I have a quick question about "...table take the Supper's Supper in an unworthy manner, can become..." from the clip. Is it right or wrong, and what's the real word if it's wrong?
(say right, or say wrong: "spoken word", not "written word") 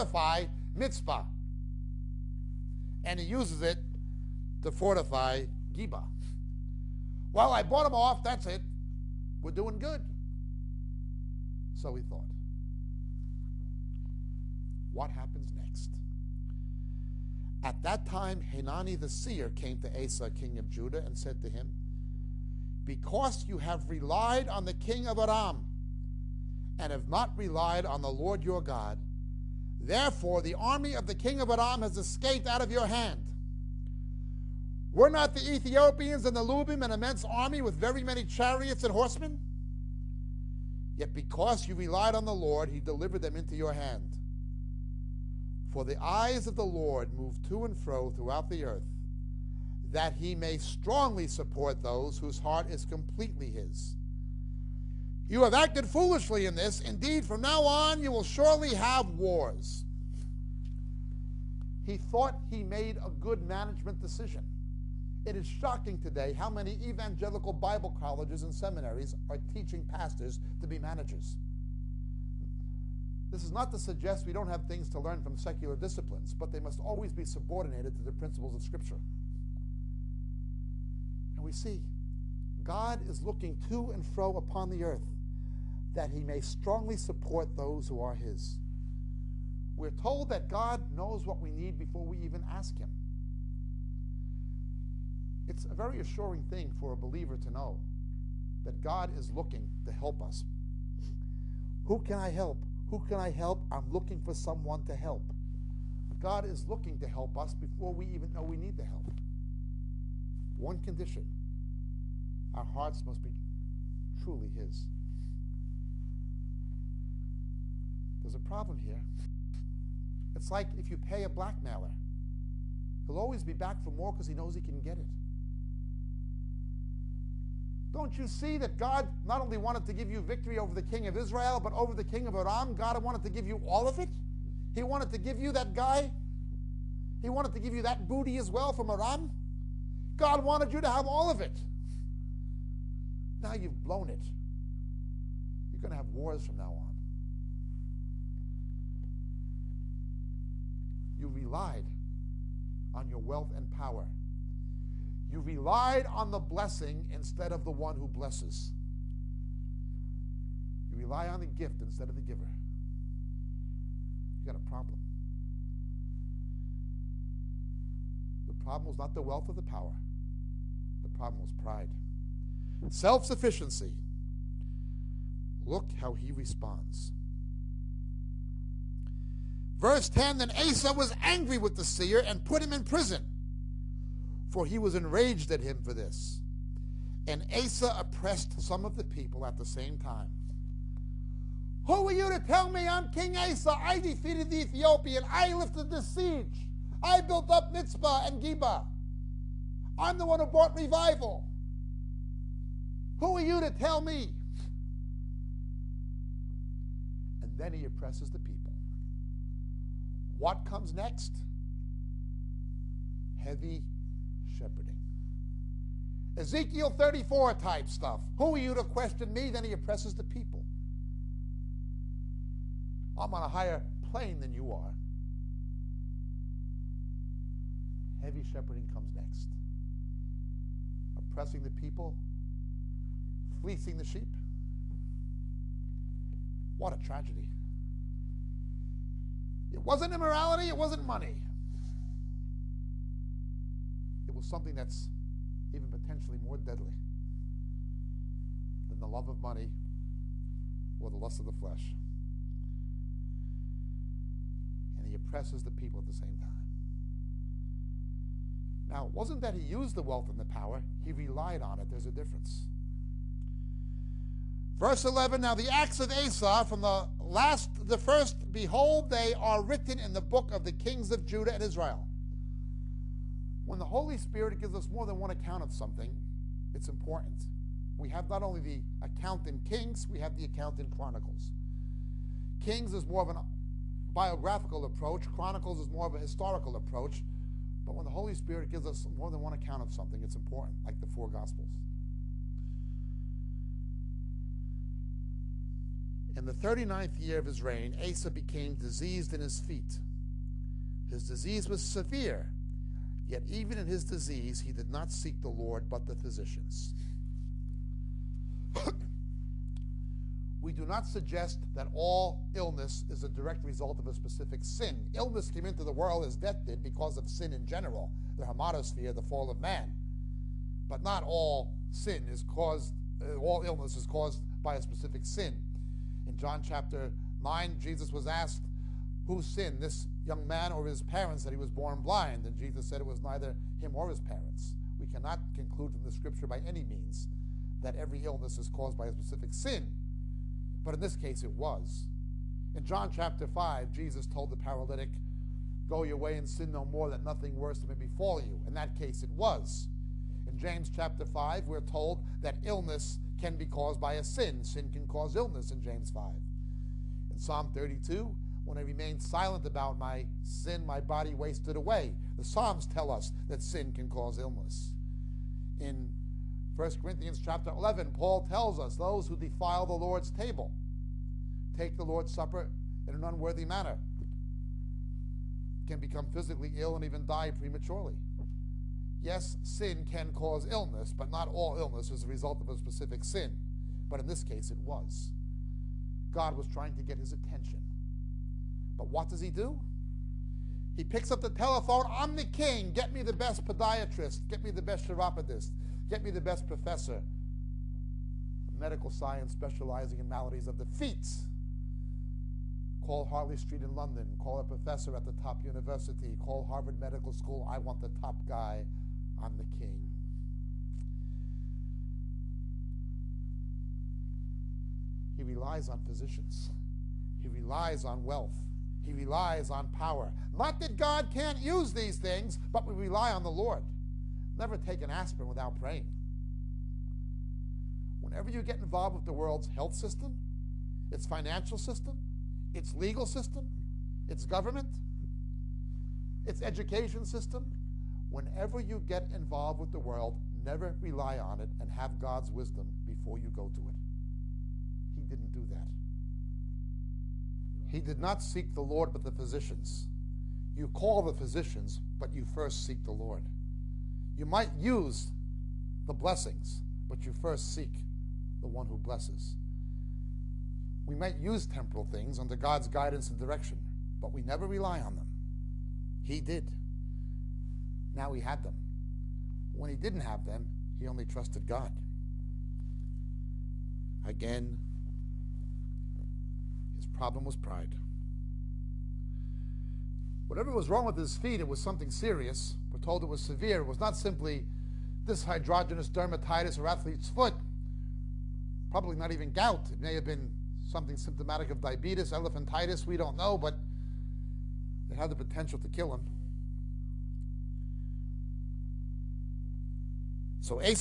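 wrong: "Lord", not "Supper".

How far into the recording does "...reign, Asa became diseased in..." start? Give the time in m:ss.
4:57.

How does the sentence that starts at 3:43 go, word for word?
I'm on a higher plane than you are.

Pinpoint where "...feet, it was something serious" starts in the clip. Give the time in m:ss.
8:01.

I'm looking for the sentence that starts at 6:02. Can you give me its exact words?
The Psalms tell us that sin can cause illness.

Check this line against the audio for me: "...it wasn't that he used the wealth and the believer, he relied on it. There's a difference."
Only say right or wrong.
wrong.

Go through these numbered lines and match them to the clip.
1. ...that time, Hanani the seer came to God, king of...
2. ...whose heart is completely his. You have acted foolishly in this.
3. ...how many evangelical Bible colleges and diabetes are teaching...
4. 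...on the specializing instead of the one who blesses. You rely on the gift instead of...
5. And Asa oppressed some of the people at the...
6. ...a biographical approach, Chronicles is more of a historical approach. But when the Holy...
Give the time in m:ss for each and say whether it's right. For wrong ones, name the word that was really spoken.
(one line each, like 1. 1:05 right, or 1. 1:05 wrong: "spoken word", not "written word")
1. 0:17 wrong: "Asa", not "God"
2. 0:52 right
3. 1:06 wrong: "seminaries", not "diabetes"
4. 2:36 wrong: "blessing", not "specializing"
5. 3:07 right
6. 4:43 right.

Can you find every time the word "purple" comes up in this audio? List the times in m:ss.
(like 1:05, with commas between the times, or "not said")
not said.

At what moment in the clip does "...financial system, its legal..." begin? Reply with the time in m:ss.
7:11.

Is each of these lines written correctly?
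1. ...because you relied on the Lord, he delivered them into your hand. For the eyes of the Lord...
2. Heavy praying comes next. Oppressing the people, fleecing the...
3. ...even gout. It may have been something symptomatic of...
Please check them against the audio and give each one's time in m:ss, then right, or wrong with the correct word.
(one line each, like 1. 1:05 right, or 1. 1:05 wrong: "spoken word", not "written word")
1. 0:41 right
2. 3:48 wrong: "shepherding", not "praying"
3. 8:09 right.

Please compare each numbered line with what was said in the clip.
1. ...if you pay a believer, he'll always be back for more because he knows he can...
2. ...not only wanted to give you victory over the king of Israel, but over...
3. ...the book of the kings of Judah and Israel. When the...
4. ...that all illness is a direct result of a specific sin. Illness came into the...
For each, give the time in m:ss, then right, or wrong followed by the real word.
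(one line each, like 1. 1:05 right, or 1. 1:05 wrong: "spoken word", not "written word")
1. 2:00 wrong: "blackmailer", not "believer"
2. 2:09 right
3. 4:30 right
4. 5:11 right.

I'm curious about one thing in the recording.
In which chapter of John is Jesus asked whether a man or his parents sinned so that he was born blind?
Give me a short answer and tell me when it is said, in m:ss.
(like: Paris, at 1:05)
John chapter 9, at 5:26.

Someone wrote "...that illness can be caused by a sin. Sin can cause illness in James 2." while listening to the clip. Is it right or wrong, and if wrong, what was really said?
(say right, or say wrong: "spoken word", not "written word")
wrong: "5", not "2".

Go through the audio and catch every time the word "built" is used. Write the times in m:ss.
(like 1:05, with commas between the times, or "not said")
3:17.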